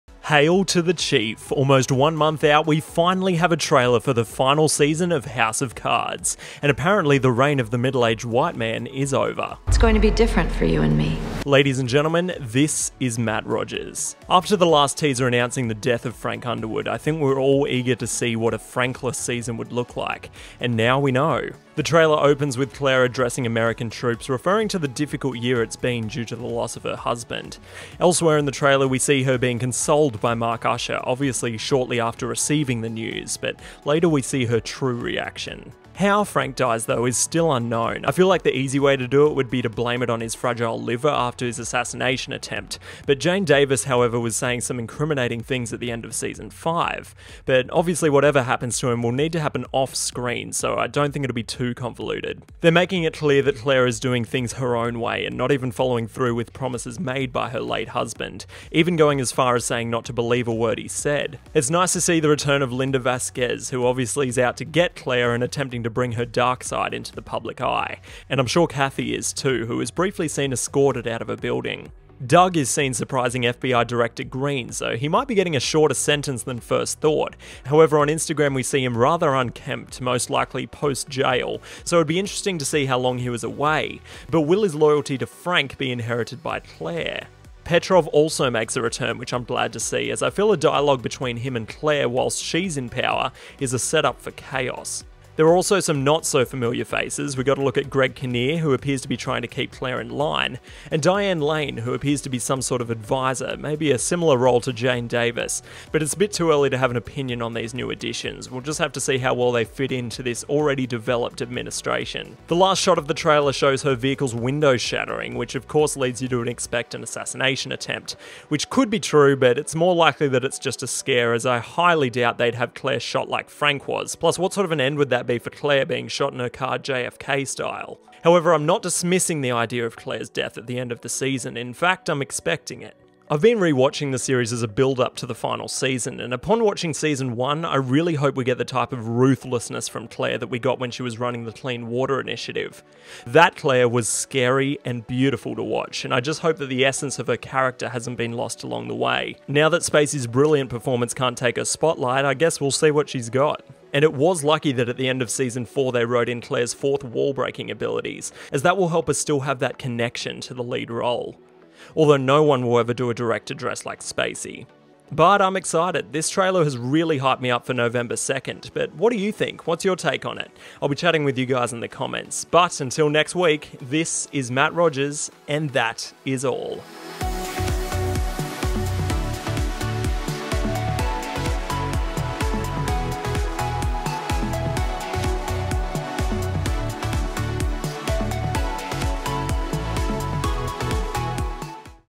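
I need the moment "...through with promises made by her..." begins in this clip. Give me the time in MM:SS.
00:56.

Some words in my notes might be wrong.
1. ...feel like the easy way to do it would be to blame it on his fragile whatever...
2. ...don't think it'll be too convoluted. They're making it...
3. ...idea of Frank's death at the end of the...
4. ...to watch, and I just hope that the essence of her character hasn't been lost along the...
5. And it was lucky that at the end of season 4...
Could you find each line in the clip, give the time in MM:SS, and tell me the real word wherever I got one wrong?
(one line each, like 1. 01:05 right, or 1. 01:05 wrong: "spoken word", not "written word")
1. 00:38 wrong: "liver", not "whatever"
2. 00:50 right
3. 02:09 wrong: "Claire", not "Frank"
4. 02:25 right
5. 02:33 right.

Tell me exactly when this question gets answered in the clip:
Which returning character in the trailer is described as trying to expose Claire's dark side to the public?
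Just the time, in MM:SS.
01:02.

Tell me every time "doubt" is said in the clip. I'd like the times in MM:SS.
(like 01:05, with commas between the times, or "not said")
02:02.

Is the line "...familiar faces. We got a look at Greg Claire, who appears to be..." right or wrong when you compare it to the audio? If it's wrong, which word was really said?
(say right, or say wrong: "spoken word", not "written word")
wrong: "Kinnear", not "Claire".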